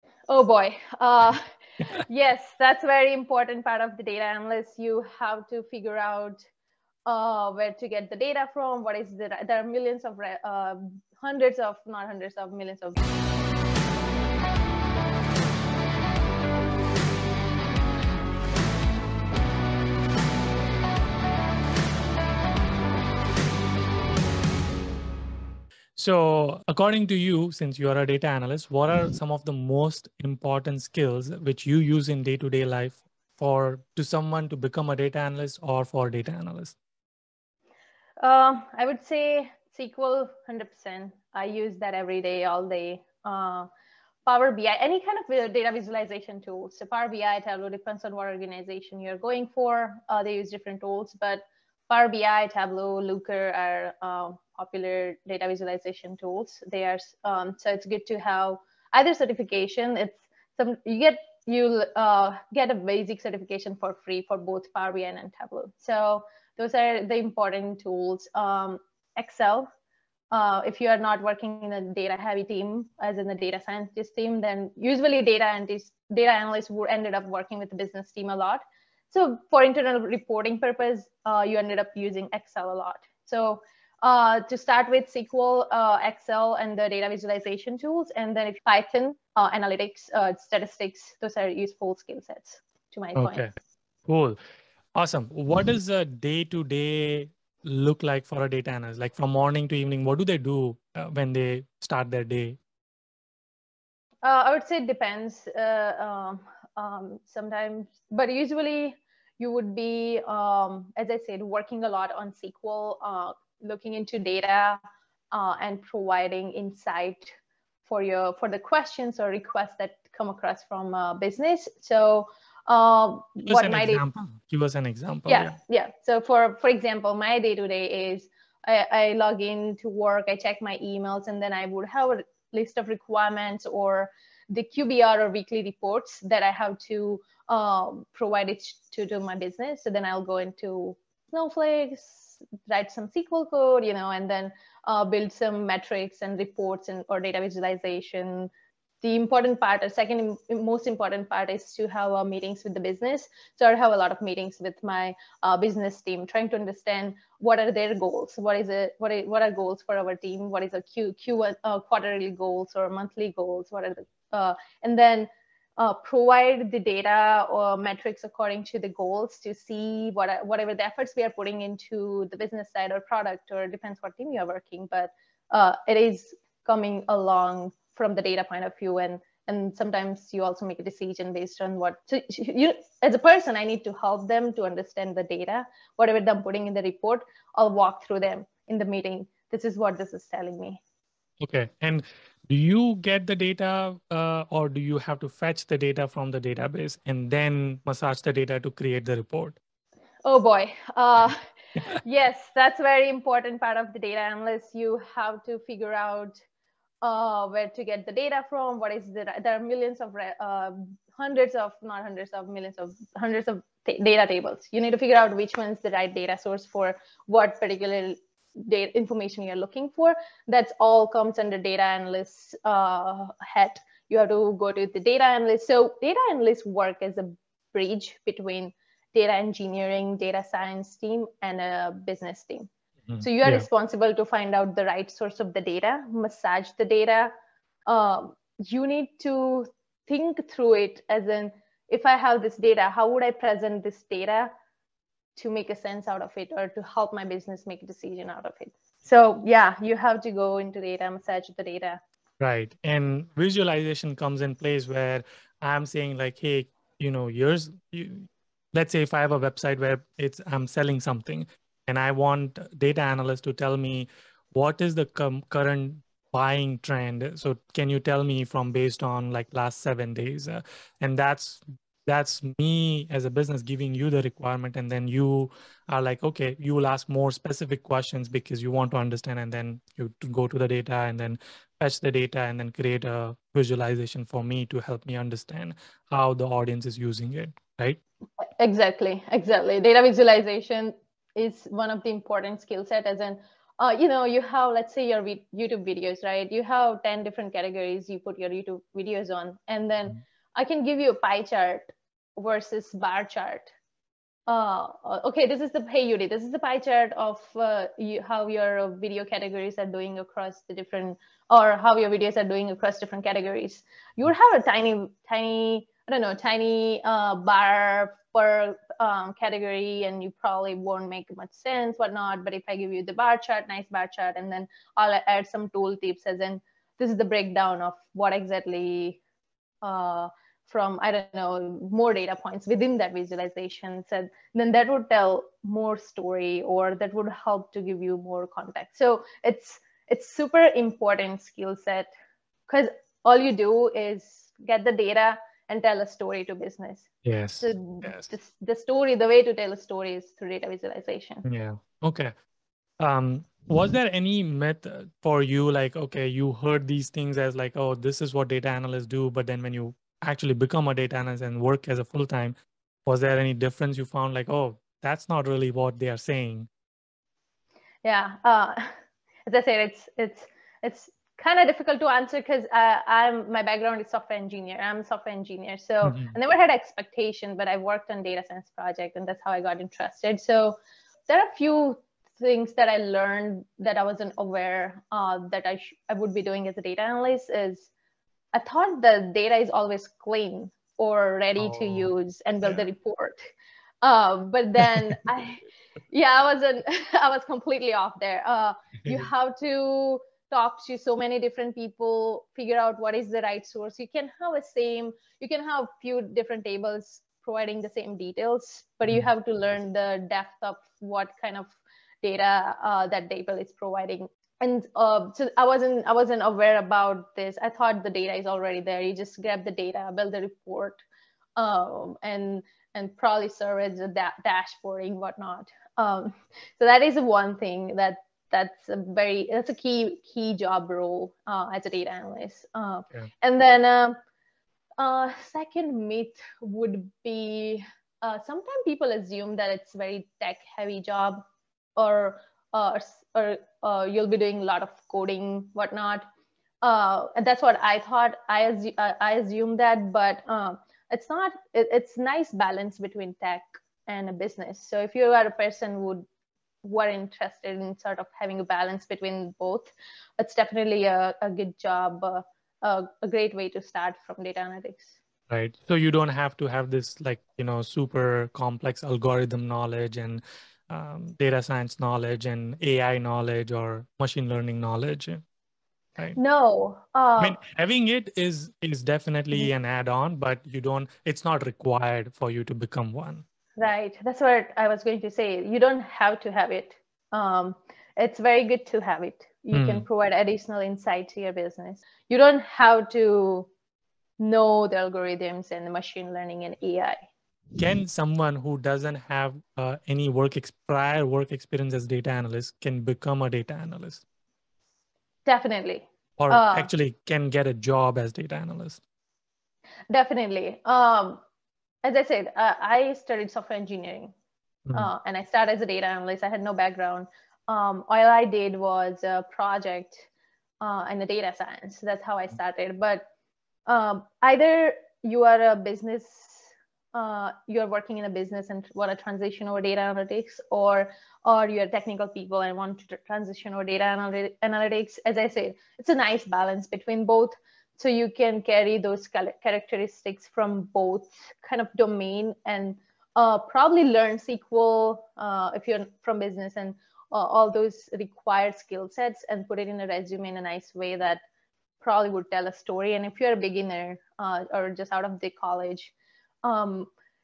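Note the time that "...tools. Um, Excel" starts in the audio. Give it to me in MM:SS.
01:07.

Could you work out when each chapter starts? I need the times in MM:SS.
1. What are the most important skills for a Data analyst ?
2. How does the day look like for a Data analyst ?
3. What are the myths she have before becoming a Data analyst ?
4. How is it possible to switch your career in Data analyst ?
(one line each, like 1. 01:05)
1. 00:24
2. 01:34
3. 05:52
4. 08:16.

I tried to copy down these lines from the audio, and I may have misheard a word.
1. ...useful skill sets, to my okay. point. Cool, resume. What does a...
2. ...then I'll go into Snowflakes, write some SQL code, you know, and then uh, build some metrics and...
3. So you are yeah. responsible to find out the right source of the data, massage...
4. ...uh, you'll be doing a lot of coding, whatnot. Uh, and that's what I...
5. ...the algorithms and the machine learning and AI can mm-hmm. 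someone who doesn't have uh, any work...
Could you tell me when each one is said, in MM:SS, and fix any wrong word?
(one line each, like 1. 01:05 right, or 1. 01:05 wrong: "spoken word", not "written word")
1. 01:31 wrong: "awesome", not "resume"
2. 02:19 right
3. 03:53 right
4. 07:23 right
5. 08:14 right.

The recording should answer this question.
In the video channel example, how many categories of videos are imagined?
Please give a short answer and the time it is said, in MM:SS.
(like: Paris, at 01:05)
10, at 04:57.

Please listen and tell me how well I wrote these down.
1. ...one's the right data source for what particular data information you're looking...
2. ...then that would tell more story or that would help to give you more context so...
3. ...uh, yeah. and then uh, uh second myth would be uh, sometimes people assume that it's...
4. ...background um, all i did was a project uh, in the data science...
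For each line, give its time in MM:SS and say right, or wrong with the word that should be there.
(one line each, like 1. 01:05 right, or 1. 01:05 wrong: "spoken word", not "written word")
1. 03:35 right
2. 05:34 right
3. 07:12 right
4. 08:36 right.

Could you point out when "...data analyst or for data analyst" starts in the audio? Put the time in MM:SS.
00:34.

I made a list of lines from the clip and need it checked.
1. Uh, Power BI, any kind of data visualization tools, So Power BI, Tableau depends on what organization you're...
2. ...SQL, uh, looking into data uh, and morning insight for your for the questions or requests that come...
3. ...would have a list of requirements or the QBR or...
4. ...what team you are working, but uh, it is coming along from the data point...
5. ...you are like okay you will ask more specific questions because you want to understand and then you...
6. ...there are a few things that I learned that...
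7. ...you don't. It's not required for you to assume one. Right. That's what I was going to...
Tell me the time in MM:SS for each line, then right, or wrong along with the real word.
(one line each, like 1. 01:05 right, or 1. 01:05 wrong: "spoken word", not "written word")
1. 00:43 right
2. 01:52 wrong: "providing", not "morning"
3. 02:11 right
4. 02:54 right
5. 04:35 right
6. 06:21 right
7. 08:00 wrong: "become", not "assume".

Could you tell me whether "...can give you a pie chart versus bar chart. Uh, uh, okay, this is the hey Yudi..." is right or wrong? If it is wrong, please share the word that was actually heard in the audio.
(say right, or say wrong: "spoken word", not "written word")
right.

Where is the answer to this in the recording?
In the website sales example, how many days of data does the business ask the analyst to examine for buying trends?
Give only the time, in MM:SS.
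04:29.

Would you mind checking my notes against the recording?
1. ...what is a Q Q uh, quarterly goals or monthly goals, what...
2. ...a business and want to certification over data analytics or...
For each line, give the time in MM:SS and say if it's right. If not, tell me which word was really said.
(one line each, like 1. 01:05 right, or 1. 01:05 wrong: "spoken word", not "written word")
1. 02:40 right
2. 08:48 wrong: "transition", not "certification".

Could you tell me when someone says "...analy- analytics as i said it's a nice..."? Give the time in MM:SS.
08:54.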